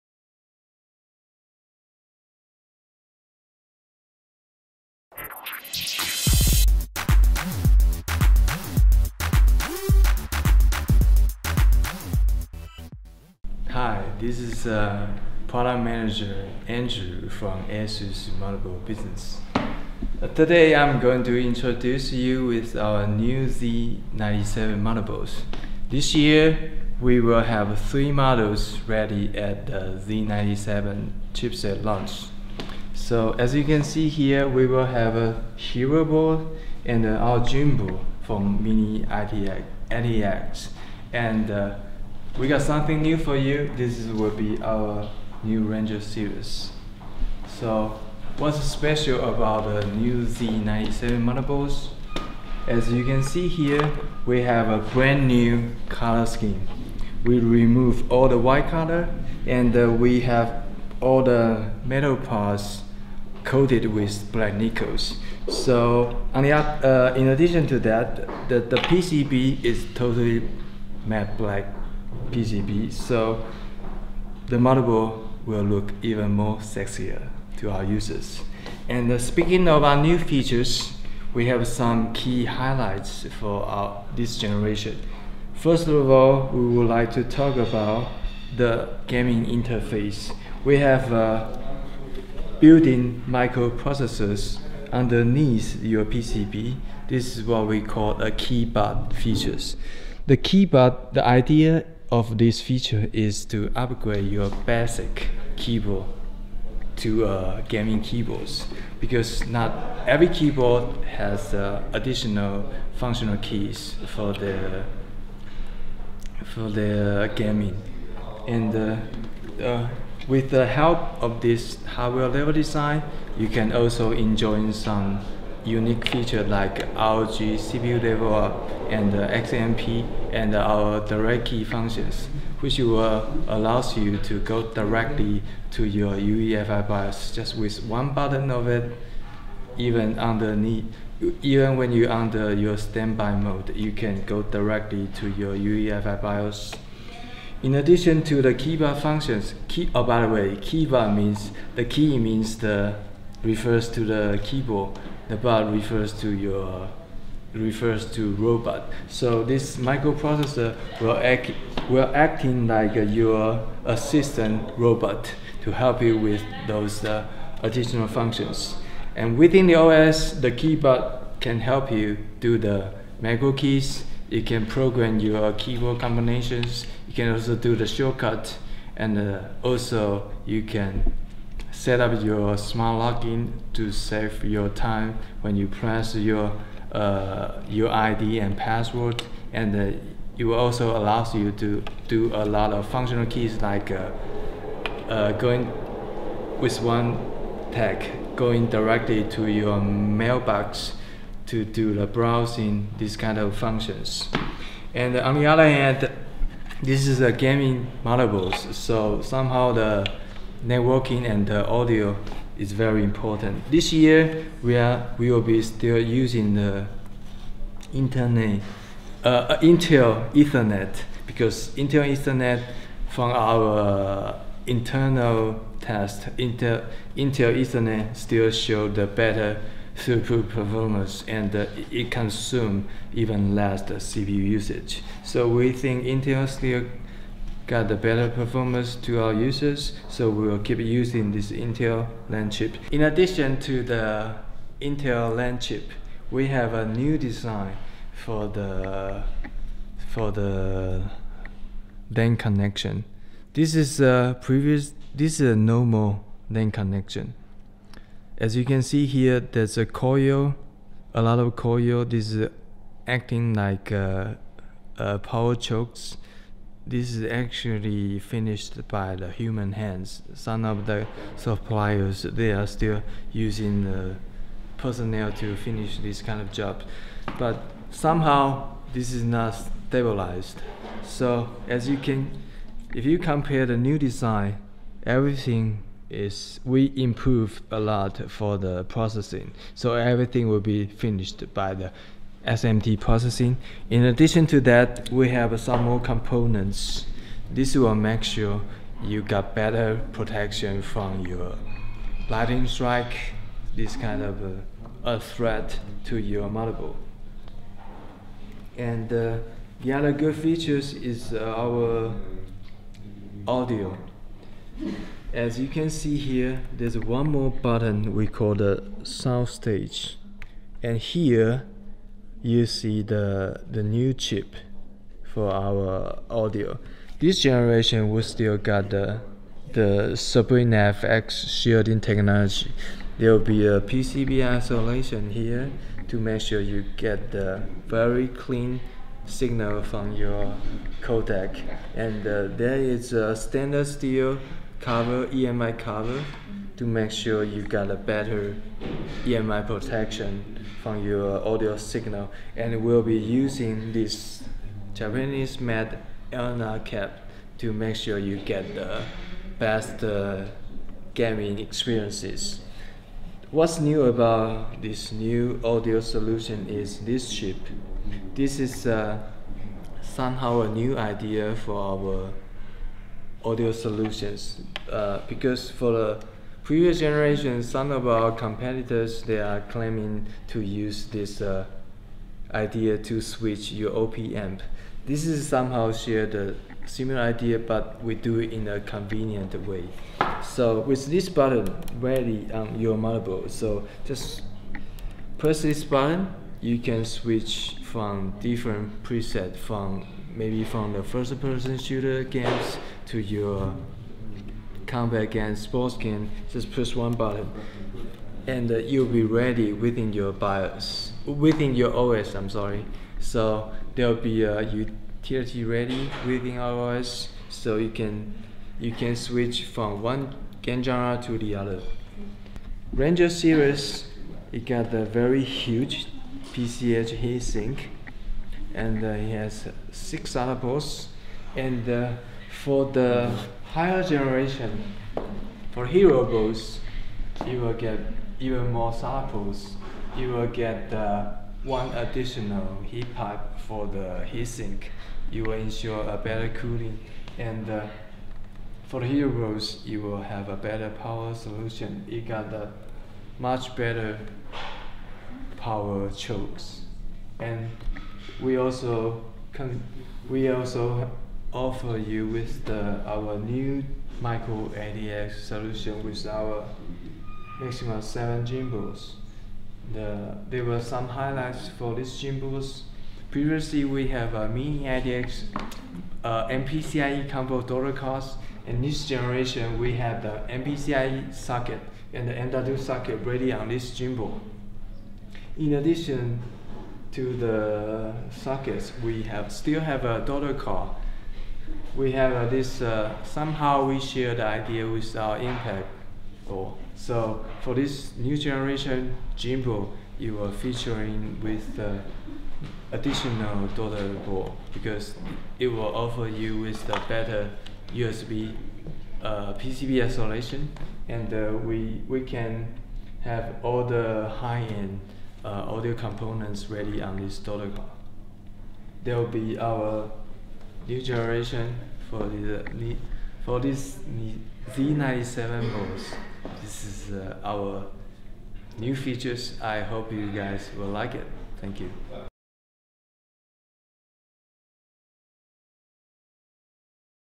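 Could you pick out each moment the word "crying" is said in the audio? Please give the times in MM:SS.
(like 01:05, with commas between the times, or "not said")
not said.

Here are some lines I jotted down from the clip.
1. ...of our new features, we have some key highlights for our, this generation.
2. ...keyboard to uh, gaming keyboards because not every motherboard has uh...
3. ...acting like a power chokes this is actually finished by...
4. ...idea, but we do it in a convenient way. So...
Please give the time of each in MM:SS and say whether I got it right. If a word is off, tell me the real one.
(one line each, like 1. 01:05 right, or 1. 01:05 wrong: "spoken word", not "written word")
1. 01:19 right
2. 01:45 wrong: "keyboard", not "motherboard"
3. 04:23 right
4. 06:27 right.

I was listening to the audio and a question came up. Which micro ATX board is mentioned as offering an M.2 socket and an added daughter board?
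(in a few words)
Maximus 7 Gene.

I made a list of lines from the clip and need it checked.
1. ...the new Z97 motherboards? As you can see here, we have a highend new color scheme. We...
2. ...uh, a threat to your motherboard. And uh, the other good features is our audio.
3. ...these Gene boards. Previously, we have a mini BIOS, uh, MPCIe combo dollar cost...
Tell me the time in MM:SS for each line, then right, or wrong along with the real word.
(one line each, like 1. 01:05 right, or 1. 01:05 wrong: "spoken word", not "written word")
1. 00:49 wrong: "brand", not "highend"
2. 05:05 right
3. 07:51 wrong: "ADX", not "BIOS".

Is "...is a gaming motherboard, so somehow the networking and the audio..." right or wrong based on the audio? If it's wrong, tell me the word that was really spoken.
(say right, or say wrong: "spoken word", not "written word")
right.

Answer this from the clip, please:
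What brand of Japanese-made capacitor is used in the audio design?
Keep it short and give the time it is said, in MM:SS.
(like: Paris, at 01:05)
Elna, at 05:56.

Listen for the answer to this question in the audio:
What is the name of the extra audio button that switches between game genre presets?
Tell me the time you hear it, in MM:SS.
05:19.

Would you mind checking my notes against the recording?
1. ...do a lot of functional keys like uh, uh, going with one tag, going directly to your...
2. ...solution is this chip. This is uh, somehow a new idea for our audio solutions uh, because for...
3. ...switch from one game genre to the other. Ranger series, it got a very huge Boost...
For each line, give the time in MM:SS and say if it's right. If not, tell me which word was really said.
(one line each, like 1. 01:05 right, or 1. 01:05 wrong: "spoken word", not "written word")
1. 03:12 right
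2. 06:05 right
3. 06:59 wrong: "PCH", not "Boost".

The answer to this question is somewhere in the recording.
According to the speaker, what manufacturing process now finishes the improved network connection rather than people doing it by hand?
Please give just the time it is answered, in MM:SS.
04:52.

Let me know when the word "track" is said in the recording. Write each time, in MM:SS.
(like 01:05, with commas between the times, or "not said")
not said.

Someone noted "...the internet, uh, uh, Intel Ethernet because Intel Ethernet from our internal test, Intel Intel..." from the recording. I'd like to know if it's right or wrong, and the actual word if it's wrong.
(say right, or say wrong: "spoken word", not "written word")
right.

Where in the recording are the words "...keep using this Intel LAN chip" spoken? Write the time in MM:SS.
04:00.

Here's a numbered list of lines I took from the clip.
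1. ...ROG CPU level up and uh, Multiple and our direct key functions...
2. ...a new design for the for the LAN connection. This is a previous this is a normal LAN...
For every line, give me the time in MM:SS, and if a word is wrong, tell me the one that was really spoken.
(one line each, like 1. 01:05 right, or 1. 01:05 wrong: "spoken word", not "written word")
1. 02:06 wrong: "XMP", not "Multiple"
2. 04:06 right.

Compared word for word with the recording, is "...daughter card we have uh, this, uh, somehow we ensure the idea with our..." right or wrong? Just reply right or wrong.
wrong.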